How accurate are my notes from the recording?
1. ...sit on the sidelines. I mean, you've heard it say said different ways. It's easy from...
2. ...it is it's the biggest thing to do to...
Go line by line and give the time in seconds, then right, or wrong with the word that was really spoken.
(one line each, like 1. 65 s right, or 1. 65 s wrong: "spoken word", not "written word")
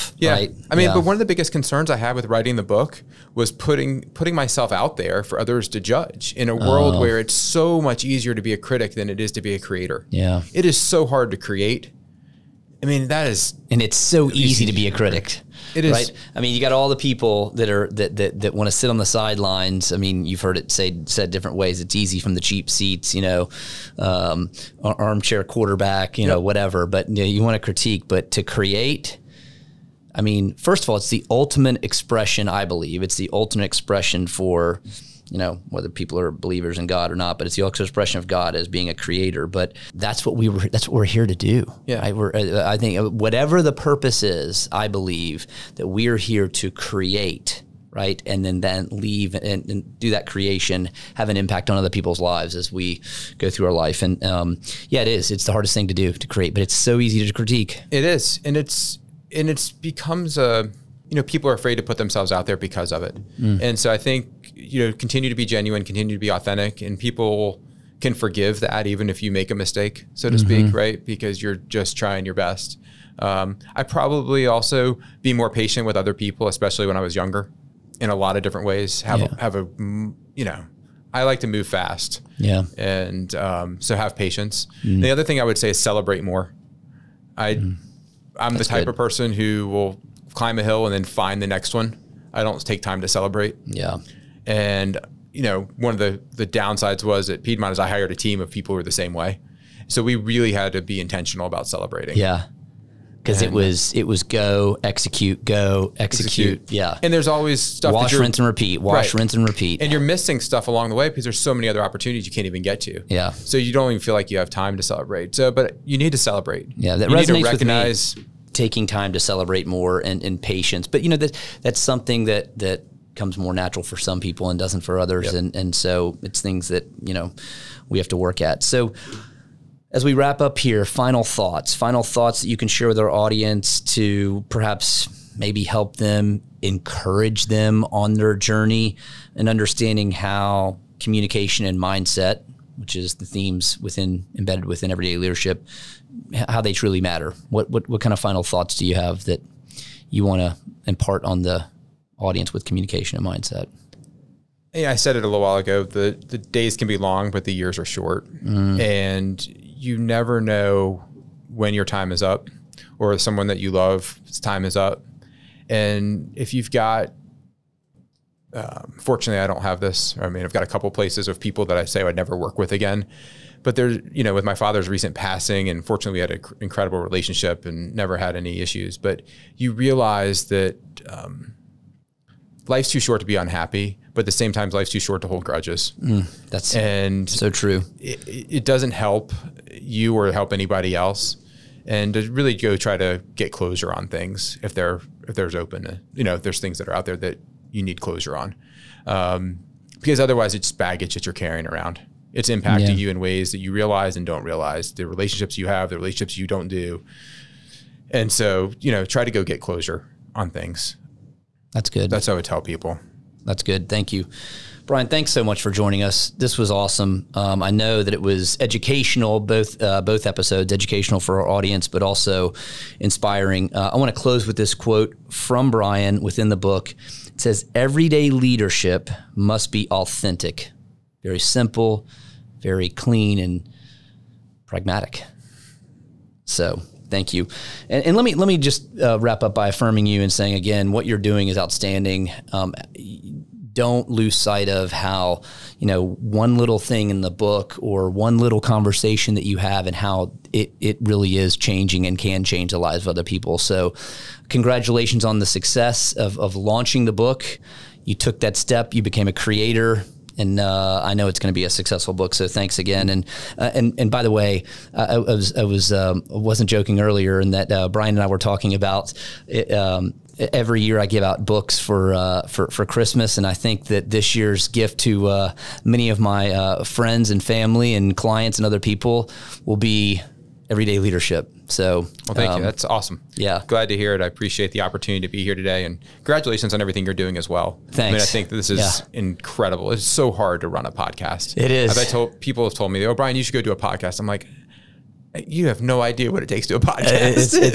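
1. 18 s right
2. 55 s wrong: "hardest", not "biggest".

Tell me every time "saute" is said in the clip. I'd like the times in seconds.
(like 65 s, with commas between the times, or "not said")
not said.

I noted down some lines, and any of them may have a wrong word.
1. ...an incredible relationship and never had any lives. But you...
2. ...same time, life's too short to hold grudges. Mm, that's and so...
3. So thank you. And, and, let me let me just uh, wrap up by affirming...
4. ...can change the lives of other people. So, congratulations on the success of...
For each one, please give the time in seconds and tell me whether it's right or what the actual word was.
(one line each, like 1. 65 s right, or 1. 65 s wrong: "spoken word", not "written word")
1. 176 s wrong: "issues", not "lives"
2. 184 s right
3. 236 s right
4. 252 s right.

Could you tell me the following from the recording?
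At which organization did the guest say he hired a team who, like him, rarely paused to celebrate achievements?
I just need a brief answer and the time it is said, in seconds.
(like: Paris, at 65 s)
Piedmont, at 97 s.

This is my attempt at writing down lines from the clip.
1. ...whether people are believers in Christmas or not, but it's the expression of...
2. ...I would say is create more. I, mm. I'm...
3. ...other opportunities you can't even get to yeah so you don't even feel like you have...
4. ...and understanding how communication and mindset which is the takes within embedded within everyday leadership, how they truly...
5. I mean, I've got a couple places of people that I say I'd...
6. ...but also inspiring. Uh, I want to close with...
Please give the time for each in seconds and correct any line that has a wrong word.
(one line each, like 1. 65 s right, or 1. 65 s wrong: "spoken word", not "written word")
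1. 35 s wrong: "God", not "Christmas"
2. 85 s wrong: "celebrate", not "create"
3. 111 s right
4. 139 s wrong: "themes", not "takes"
5. 170 s right
6. 221 s right.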